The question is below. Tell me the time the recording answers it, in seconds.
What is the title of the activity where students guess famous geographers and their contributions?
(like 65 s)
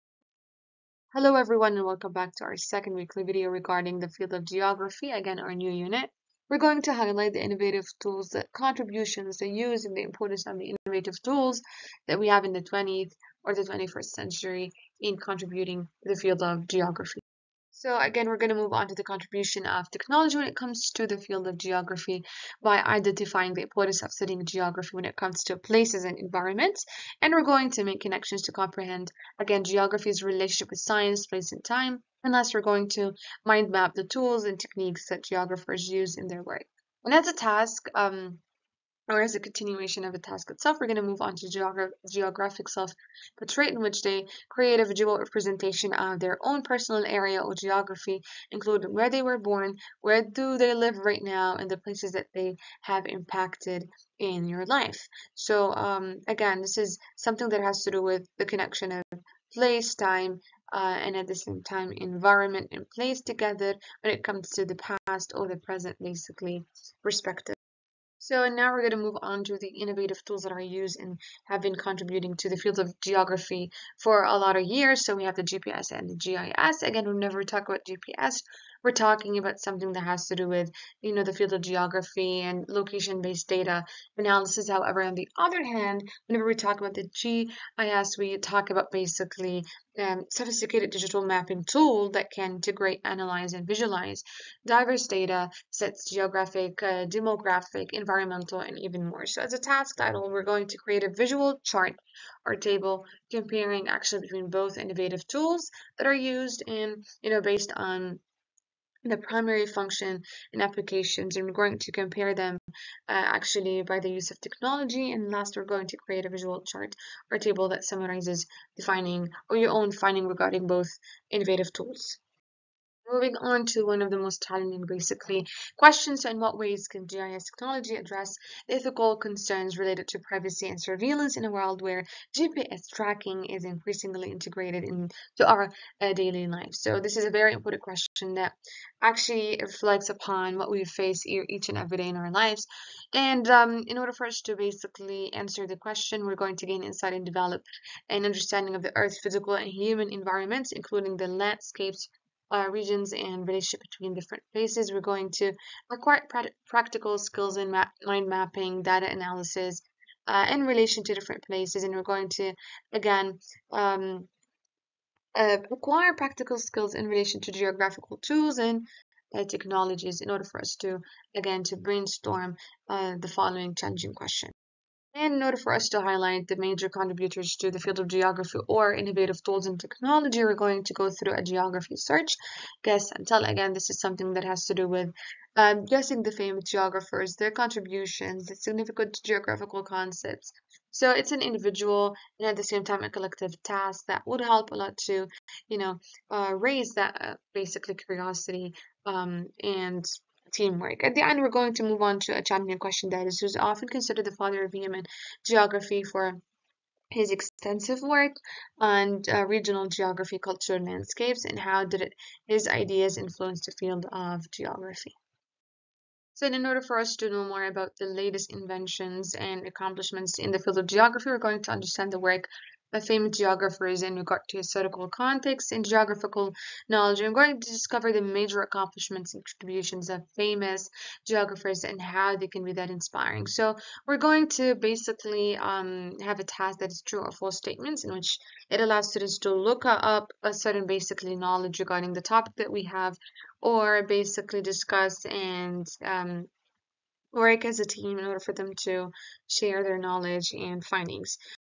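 182 s.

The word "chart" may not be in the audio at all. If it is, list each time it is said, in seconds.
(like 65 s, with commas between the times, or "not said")
101 s, 116 s.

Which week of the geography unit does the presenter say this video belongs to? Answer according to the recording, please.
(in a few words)
second.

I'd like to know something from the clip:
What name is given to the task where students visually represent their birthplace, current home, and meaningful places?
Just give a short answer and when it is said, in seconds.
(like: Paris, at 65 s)
geographic self, at 42 s.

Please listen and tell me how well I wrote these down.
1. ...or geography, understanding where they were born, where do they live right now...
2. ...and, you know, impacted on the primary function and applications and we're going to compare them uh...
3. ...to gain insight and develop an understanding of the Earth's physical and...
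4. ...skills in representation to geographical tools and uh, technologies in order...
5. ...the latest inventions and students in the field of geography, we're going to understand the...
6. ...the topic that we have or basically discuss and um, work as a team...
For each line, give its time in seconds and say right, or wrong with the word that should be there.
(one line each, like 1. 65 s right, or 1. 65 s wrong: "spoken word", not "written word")
1. 47 s wrong: "including", not "understanding"
2. 106 s wrong: "based", not "impacted"
3. 146 s right
4. 166 s wrong: "relation", not "representation"
5. 217 s wrong: "accomplishments", not "students"
6. 242 s right.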